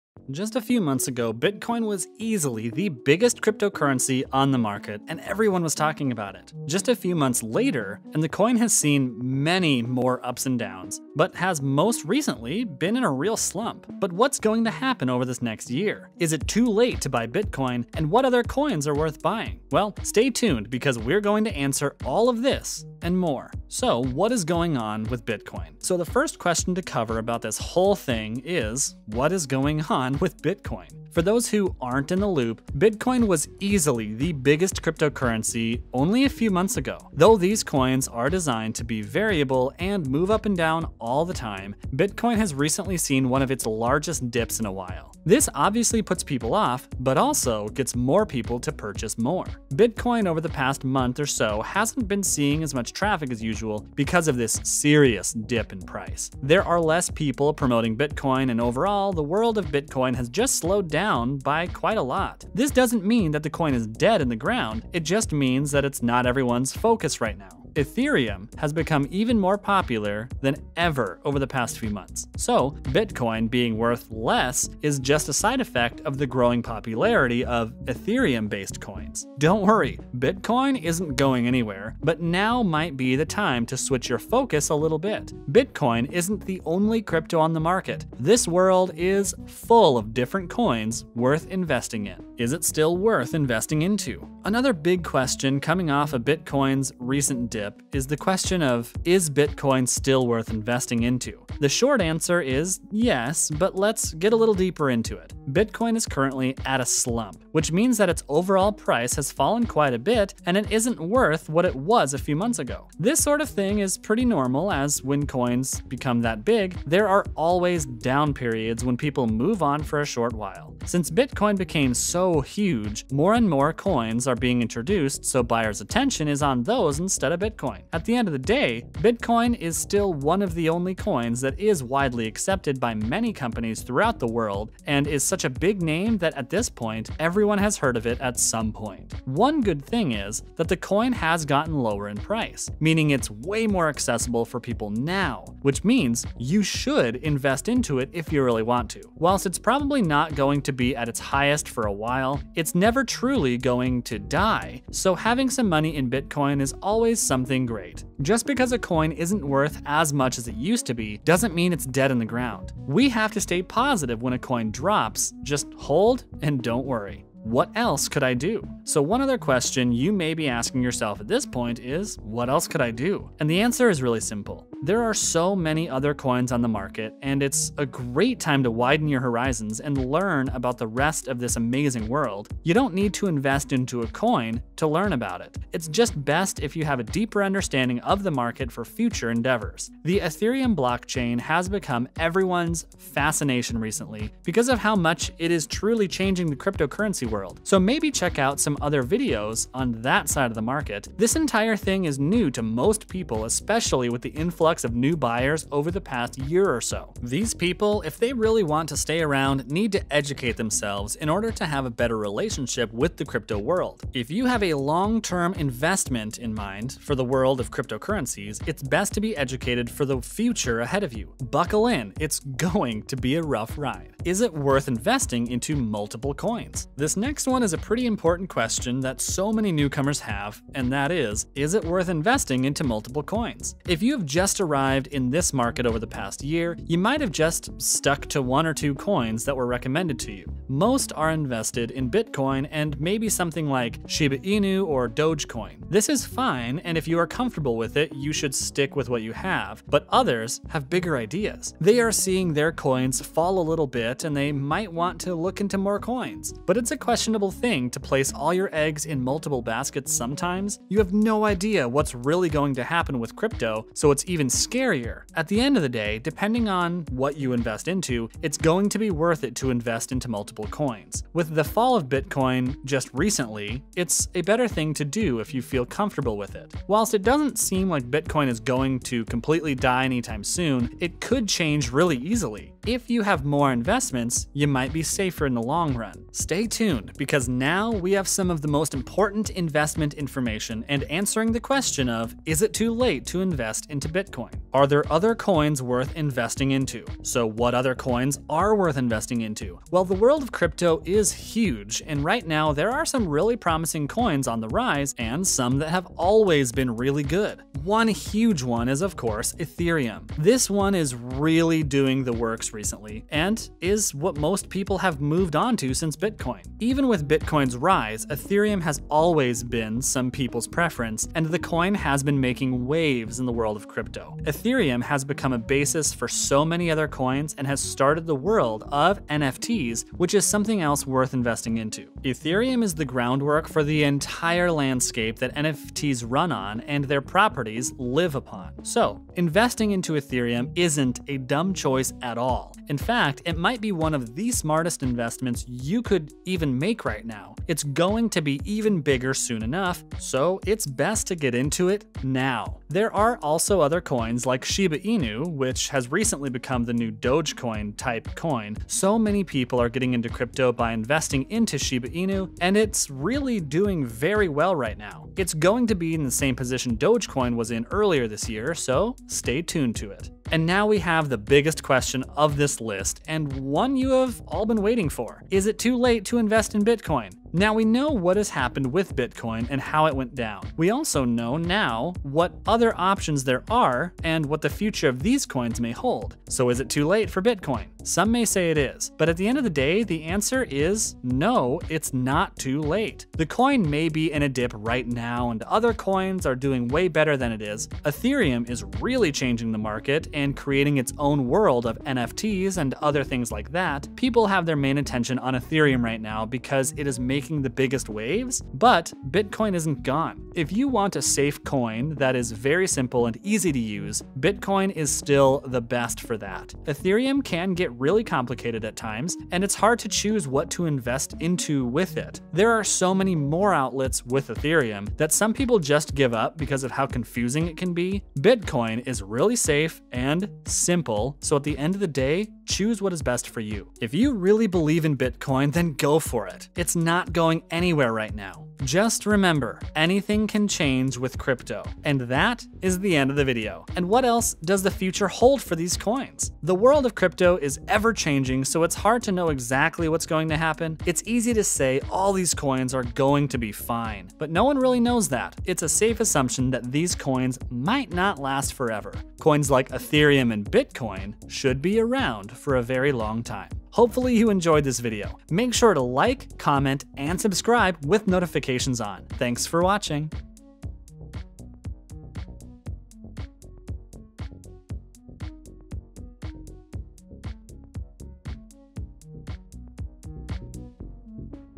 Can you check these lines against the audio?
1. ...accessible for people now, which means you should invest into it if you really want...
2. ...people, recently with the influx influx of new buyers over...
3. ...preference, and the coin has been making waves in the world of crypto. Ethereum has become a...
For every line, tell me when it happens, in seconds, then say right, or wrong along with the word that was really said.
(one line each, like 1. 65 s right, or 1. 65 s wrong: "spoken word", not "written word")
1. 143 s right
2. 203 s wrong: "especially", not "recently"
3. 320 s right.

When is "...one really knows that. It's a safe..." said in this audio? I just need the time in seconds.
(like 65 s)
454 s.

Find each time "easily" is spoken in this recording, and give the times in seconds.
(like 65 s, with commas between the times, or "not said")
2 s, 33 s, 282 s.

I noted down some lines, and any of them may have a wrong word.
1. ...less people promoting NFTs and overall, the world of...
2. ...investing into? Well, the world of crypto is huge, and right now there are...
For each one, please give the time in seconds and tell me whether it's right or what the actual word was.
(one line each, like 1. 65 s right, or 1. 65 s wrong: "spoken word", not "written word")
1. 56 s wrong: "Bitcoin", not "NFTs"
2. 298 s right.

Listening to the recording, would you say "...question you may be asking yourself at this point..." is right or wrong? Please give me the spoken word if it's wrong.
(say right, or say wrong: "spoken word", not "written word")
right.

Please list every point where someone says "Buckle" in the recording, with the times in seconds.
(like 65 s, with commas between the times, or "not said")
221 s.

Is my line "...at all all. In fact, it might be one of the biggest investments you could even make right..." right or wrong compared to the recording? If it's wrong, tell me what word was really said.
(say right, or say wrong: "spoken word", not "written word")
wrong: "smartest", not "biggest".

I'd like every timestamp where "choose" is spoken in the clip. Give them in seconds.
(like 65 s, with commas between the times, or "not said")
420 s, 432 s.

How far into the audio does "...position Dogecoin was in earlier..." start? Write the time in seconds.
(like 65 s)
366 s.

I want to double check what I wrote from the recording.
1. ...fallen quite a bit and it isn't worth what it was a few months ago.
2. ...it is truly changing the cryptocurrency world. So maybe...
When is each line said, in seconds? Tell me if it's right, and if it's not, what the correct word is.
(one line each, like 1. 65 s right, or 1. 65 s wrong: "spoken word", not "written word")
1. 109 s right
2. 195 s right.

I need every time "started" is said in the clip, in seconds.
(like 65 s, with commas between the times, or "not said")
327 s.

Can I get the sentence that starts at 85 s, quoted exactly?
Bitcoin isn't the only crypto on the market.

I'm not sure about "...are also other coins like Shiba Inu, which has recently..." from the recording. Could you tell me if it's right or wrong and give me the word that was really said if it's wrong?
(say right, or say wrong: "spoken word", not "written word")
right.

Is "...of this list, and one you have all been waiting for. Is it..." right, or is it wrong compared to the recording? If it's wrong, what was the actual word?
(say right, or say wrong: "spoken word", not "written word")
right.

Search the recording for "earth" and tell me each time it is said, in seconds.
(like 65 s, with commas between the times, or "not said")
not said.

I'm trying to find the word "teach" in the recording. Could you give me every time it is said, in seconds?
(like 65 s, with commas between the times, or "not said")
not said.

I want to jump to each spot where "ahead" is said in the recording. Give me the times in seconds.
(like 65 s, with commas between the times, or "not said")
220 s.